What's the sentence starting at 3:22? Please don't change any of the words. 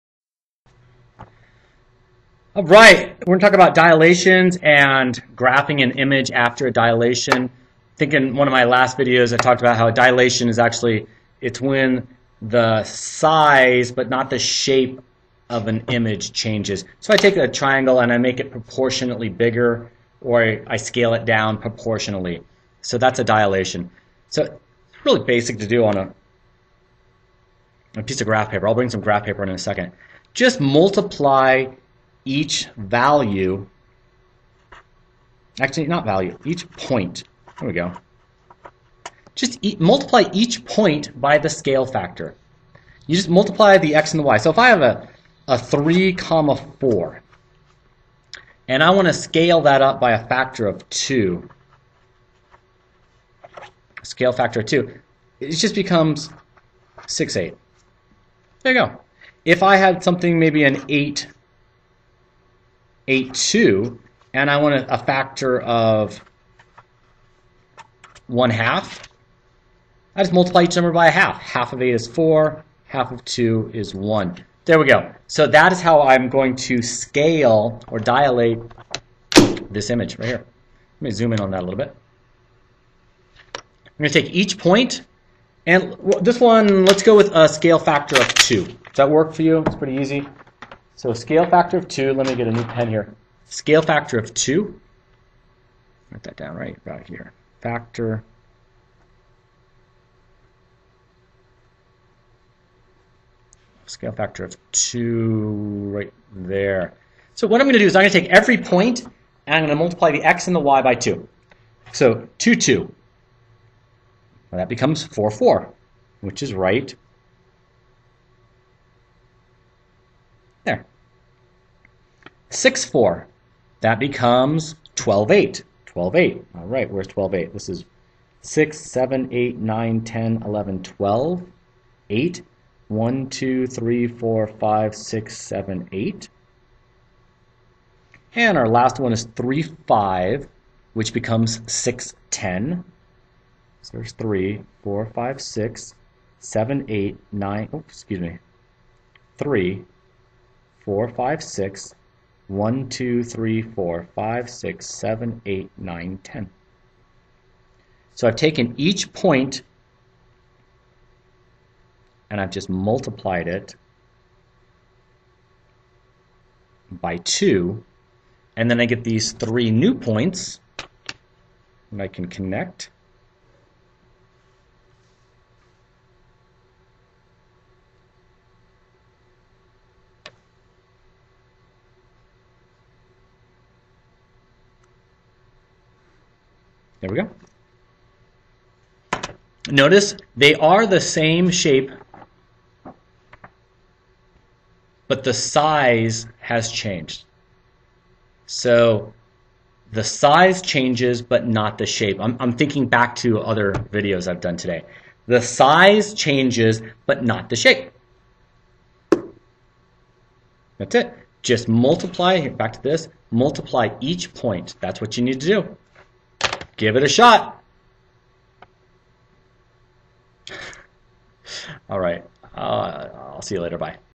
I'm, I'm thinking back to other videos I've done today.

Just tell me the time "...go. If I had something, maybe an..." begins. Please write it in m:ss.
0:58.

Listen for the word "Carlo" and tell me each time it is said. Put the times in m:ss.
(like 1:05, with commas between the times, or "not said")
not said.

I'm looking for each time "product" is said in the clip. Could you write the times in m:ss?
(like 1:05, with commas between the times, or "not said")
not said.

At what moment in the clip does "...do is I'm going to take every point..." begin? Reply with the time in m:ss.
1:47.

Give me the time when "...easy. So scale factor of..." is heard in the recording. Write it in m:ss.
1:29.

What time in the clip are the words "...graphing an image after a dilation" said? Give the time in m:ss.
0:05.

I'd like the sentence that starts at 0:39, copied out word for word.
Just e multiply each point by the scale factor.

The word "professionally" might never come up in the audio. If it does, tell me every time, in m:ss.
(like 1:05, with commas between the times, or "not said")
not said.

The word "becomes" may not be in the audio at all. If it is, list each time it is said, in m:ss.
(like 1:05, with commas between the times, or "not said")
0:55, 1:54.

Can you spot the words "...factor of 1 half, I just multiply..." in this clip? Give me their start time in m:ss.
1:04.